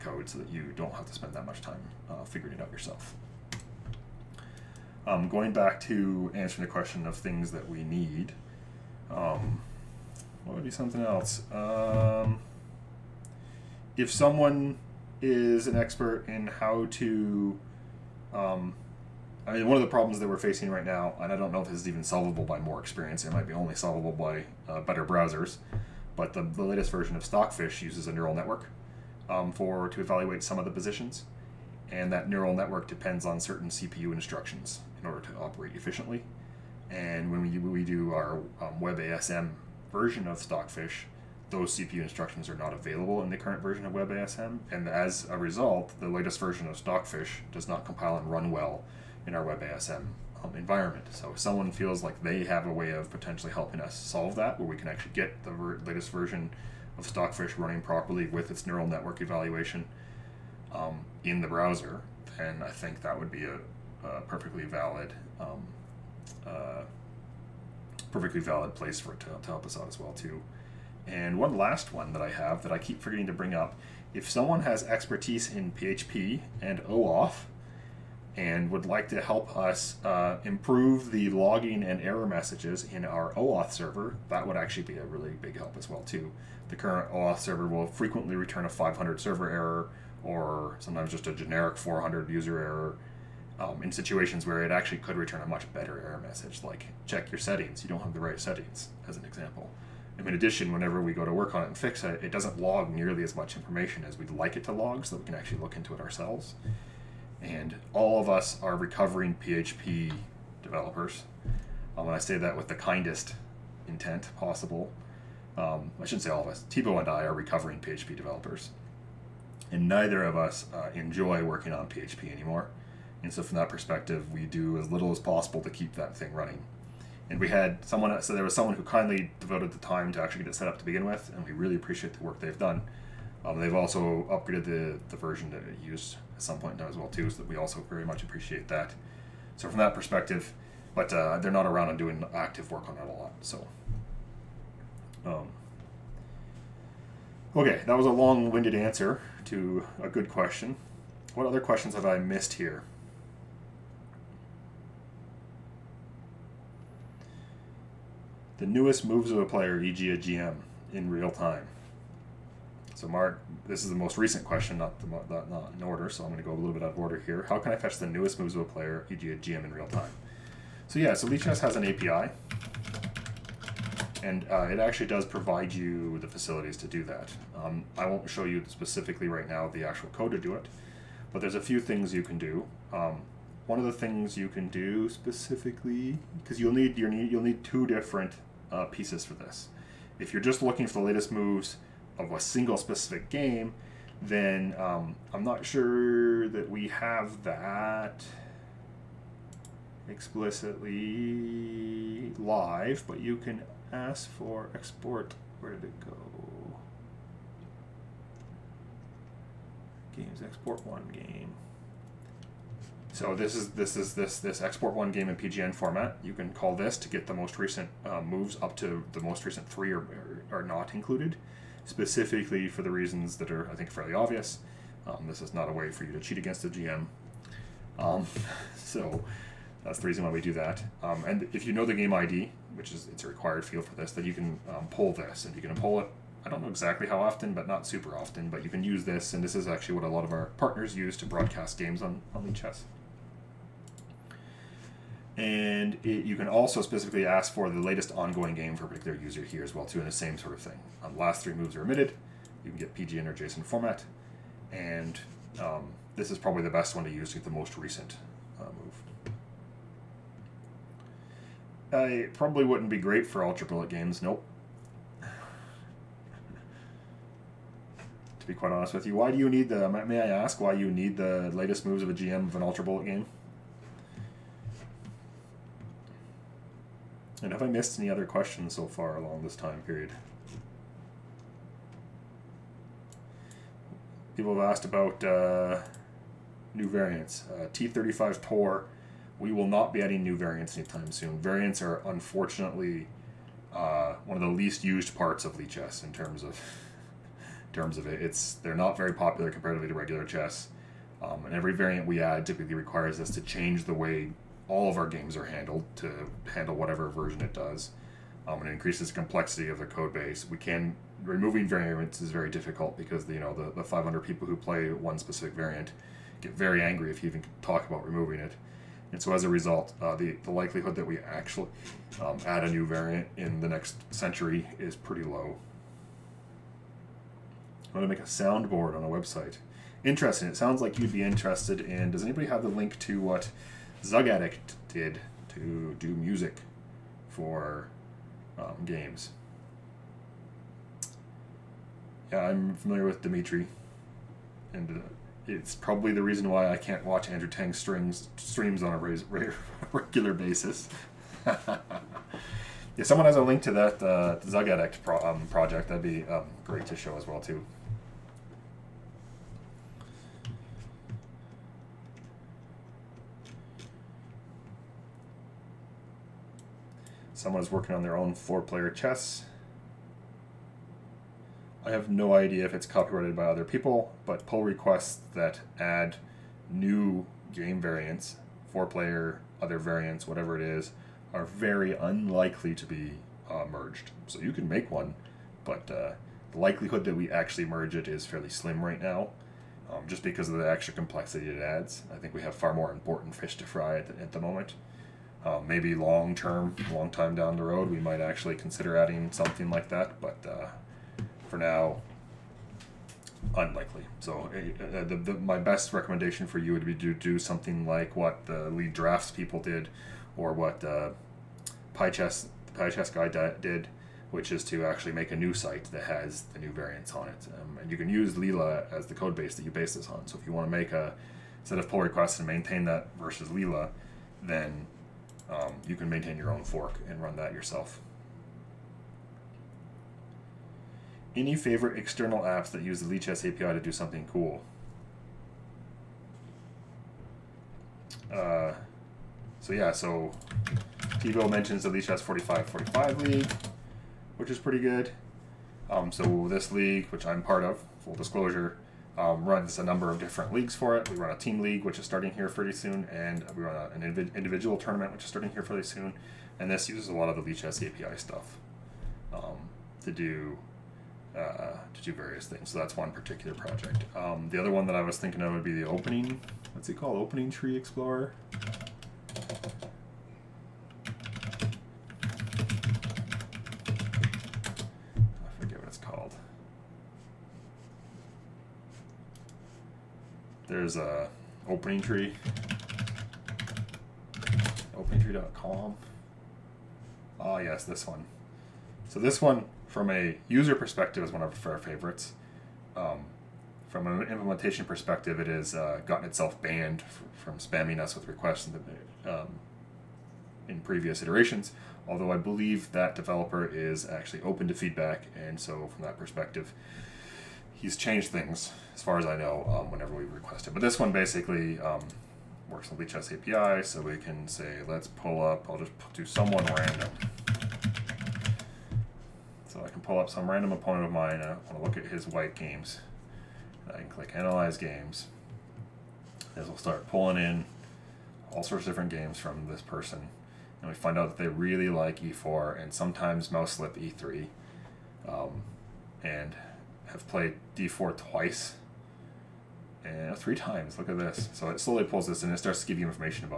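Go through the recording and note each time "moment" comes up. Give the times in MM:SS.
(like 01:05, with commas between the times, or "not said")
06:34.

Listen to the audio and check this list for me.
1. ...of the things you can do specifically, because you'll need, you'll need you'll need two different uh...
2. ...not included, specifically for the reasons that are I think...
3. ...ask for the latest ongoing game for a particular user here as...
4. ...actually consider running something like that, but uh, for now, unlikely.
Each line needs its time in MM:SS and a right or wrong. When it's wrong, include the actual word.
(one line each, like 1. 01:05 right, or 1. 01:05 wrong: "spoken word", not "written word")
1. 03:03 right
2. 03:40 right
3. 04:07 right
4. 06:38 wrong: "adding", not "running".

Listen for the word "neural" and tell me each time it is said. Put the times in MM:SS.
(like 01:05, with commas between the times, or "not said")
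00:28, 00:32, 00:58.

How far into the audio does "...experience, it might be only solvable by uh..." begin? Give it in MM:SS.
00:22.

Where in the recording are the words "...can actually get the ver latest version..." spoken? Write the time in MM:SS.
00:54.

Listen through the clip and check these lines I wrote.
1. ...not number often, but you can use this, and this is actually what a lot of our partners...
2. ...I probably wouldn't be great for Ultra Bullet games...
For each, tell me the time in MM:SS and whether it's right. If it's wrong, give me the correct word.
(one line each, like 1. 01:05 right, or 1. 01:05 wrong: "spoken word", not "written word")
1. 03:57 wrong: "super", not "number"
2. 04:21 right.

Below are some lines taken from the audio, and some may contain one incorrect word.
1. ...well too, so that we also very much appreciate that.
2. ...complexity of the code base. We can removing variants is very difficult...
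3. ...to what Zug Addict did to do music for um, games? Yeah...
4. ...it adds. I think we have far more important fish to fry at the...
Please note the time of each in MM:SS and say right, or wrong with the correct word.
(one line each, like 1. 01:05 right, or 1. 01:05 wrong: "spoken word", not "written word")
1. 02:16 right
2. 05:09 right
3. 05:32 right
4. 06:31 right.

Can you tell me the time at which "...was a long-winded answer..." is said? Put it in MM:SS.
02:27.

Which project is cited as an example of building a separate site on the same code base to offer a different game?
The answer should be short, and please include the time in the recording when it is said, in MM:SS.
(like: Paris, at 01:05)
lidraughts, at 06:48.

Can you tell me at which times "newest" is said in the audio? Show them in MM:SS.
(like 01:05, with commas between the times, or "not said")
02:38, 02:48.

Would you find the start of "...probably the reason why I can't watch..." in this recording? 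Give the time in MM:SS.
05:45.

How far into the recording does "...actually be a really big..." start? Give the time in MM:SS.
01:24.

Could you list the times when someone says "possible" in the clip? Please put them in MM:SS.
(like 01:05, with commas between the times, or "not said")
01:54, 02:05.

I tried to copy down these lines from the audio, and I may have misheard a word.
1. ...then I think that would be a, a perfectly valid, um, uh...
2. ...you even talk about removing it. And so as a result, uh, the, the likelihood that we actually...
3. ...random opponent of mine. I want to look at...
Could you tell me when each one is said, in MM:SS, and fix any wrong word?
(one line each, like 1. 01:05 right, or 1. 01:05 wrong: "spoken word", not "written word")
1. 01:02 right
2. 05:17 right
3. 08:40 right.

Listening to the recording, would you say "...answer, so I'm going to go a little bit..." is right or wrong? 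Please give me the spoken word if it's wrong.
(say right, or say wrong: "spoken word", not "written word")
wrong: "order", not "answer".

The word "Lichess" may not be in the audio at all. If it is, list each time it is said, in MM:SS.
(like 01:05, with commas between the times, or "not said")
02:51, 04:55, 07:13, 07:21, 07:37, 08:33.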